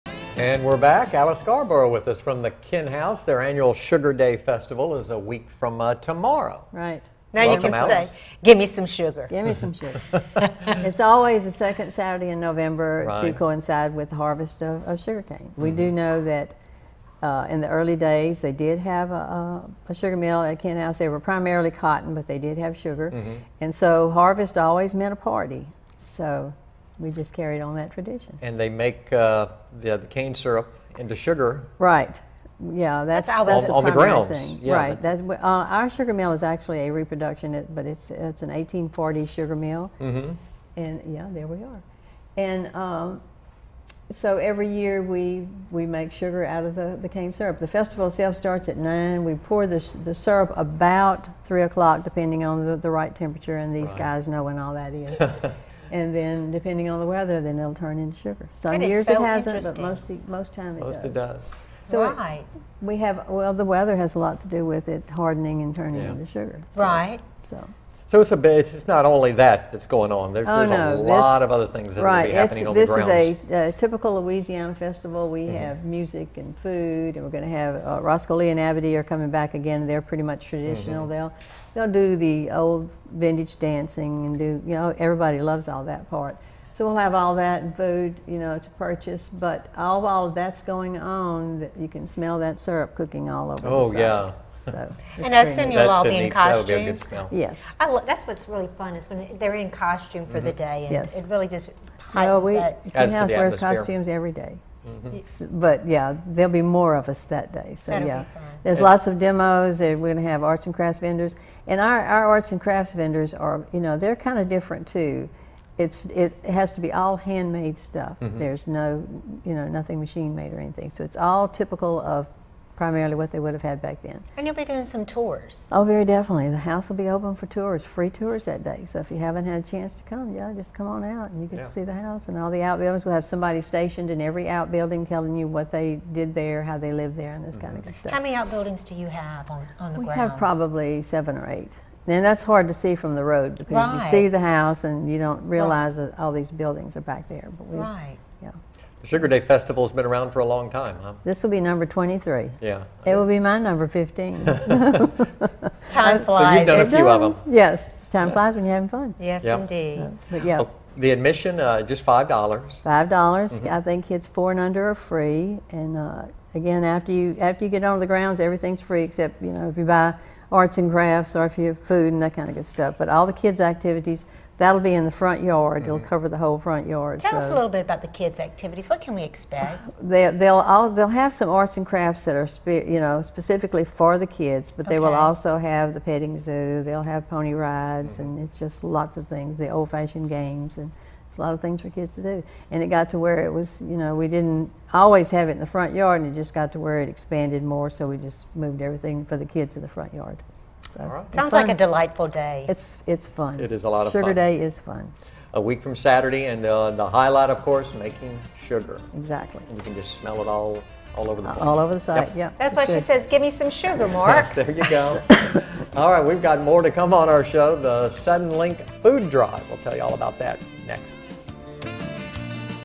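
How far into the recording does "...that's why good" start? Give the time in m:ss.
3:32.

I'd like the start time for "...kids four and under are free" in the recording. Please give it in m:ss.
2:44.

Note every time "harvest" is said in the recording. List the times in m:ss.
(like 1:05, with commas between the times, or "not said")
0:14, 0:24.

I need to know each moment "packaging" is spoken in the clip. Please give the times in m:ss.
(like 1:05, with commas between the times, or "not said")
not said.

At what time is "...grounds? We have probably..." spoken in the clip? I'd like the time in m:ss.
2:20.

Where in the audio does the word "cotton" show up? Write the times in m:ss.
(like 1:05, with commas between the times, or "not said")
0:21.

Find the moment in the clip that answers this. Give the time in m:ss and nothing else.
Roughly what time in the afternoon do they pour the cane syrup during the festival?
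0:51.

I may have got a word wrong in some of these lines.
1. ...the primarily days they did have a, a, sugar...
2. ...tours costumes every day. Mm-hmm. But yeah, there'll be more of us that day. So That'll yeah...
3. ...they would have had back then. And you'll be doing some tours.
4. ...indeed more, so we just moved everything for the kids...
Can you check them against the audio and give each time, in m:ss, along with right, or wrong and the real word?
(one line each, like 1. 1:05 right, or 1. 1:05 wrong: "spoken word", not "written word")
1. 0:17 wrong: "early", not "primarily"
2. 1:43 wrong: "wears", not "tours"
3. 2:03 right
4. 3:17 wrong: "expanded", not "indeed".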